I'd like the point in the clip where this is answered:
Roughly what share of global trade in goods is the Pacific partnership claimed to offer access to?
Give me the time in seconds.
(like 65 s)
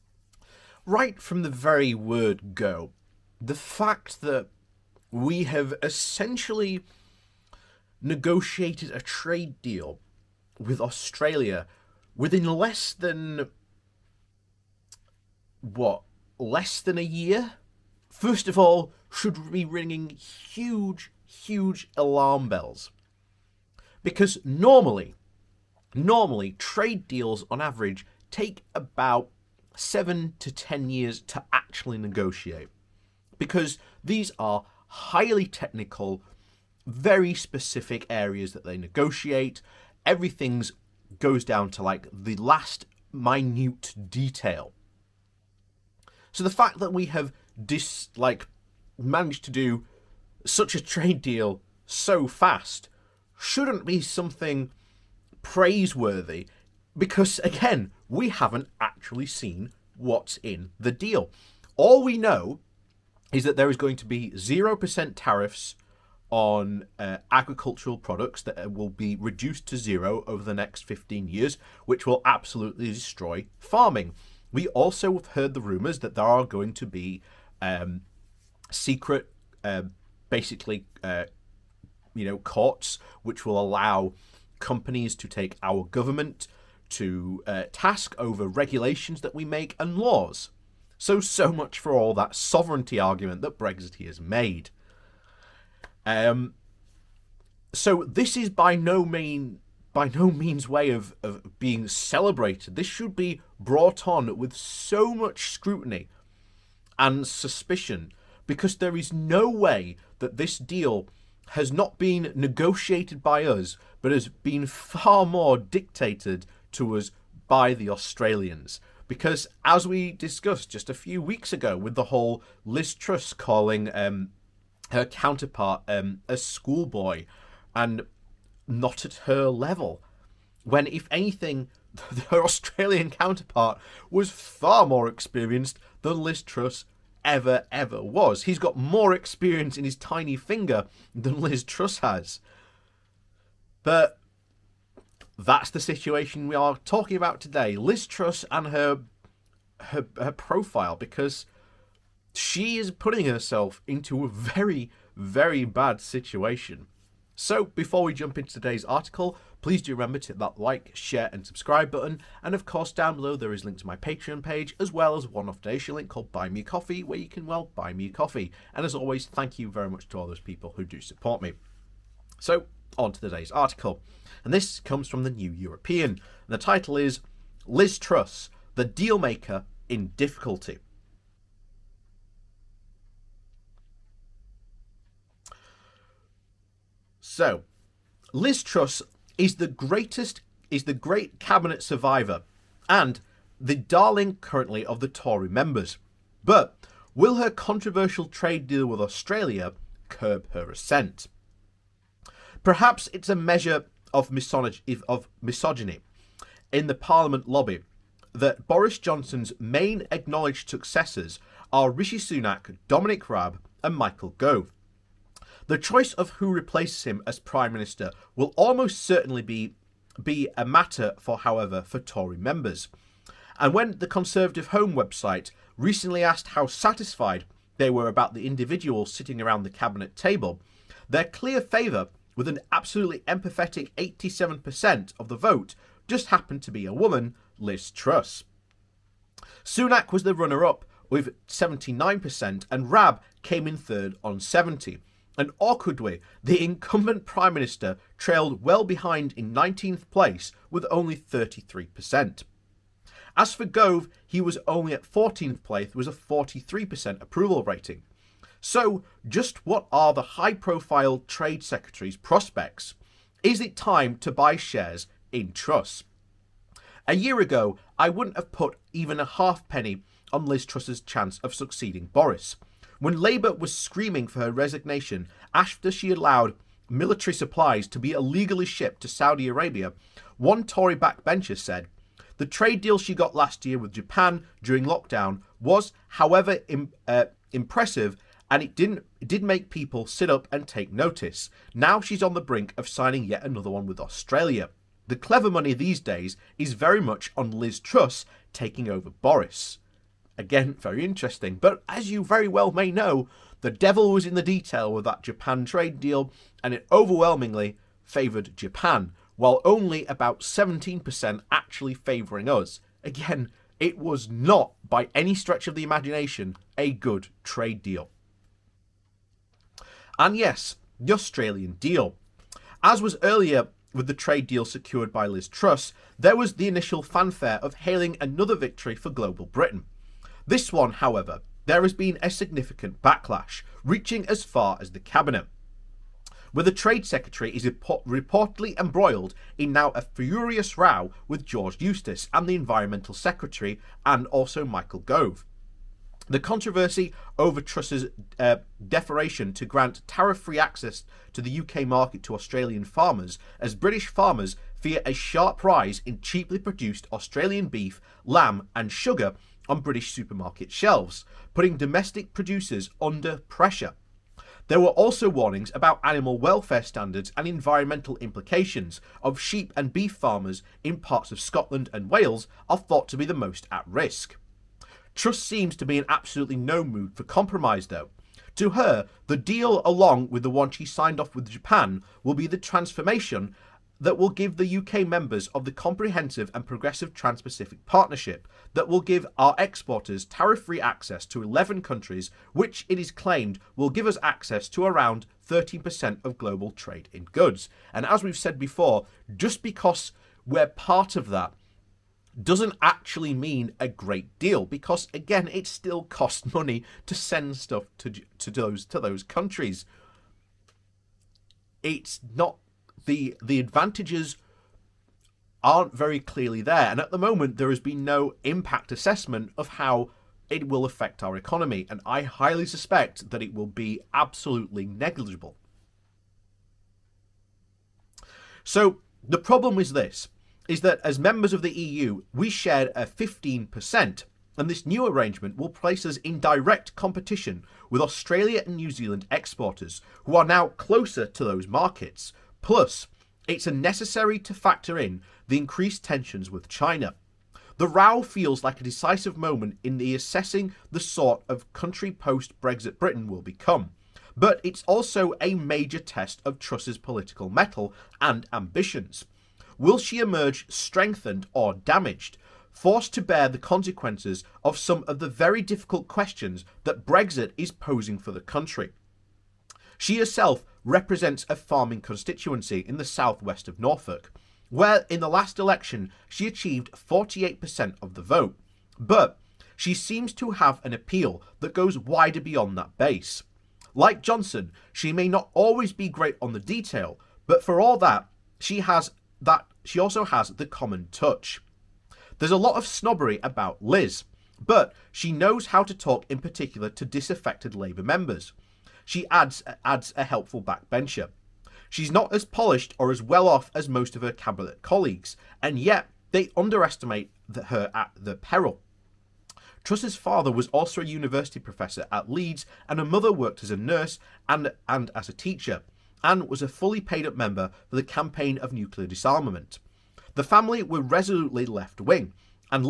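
395 s.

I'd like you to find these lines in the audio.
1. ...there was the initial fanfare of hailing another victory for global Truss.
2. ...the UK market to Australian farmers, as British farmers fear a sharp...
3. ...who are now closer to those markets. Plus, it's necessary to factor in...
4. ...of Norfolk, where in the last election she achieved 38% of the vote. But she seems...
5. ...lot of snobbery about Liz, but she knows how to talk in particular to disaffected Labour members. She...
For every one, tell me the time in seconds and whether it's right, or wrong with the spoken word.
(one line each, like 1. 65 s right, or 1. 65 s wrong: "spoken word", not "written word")
1. 326 s wrong: "Britain", not "Truss"
2. 351 s right
3. 440 s right
4. 473 s wrong: "48", not "38"
5. 492 s right.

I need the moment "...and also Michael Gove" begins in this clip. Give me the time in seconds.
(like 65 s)
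344 s.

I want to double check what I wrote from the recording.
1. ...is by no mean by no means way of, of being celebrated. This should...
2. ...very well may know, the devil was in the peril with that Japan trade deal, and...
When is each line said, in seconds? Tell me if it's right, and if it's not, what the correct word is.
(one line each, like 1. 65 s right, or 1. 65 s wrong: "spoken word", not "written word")
1. 98 s right
2. 302 s wrong: "detail", not "peril".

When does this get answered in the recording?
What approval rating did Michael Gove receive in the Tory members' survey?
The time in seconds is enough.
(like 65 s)
256 s.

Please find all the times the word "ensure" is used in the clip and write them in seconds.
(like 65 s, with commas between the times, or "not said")
not said.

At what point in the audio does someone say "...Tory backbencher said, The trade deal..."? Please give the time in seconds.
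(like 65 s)
280 s.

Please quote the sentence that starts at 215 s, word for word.
The choice of who replaces him as Prime Minister will almost certainly be, be a matter for, however, for Tory members.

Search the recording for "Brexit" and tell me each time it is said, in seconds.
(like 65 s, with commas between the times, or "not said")
93 s, 452 s, 467 s.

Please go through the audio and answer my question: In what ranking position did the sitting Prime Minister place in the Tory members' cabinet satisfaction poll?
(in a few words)
19th.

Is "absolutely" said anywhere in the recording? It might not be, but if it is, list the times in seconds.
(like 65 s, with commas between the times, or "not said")
72 s, 232 s, 376 s, 424 s.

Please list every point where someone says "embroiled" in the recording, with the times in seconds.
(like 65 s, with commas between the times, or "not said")
338 s.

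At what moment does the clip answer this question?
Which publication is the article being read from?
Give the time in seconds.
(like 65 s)
175 s.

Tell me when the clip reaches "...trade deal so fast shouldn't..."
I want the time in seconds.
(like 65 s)
50 s.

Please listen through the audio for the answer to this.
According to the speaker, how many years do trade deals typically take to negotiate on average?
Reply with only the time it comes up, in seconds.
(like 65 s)
29 s.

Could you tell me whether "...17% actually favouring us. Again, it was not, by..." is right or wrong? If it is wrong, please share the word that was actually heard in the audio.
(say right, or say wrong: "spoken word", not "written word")
right.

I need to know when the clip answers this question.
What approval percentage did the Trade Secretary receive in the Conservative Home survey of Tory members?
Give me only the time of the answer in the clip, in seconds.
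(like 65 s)
233 s.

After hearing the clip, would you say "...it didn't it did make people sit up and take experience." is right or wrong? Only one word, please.
wrong.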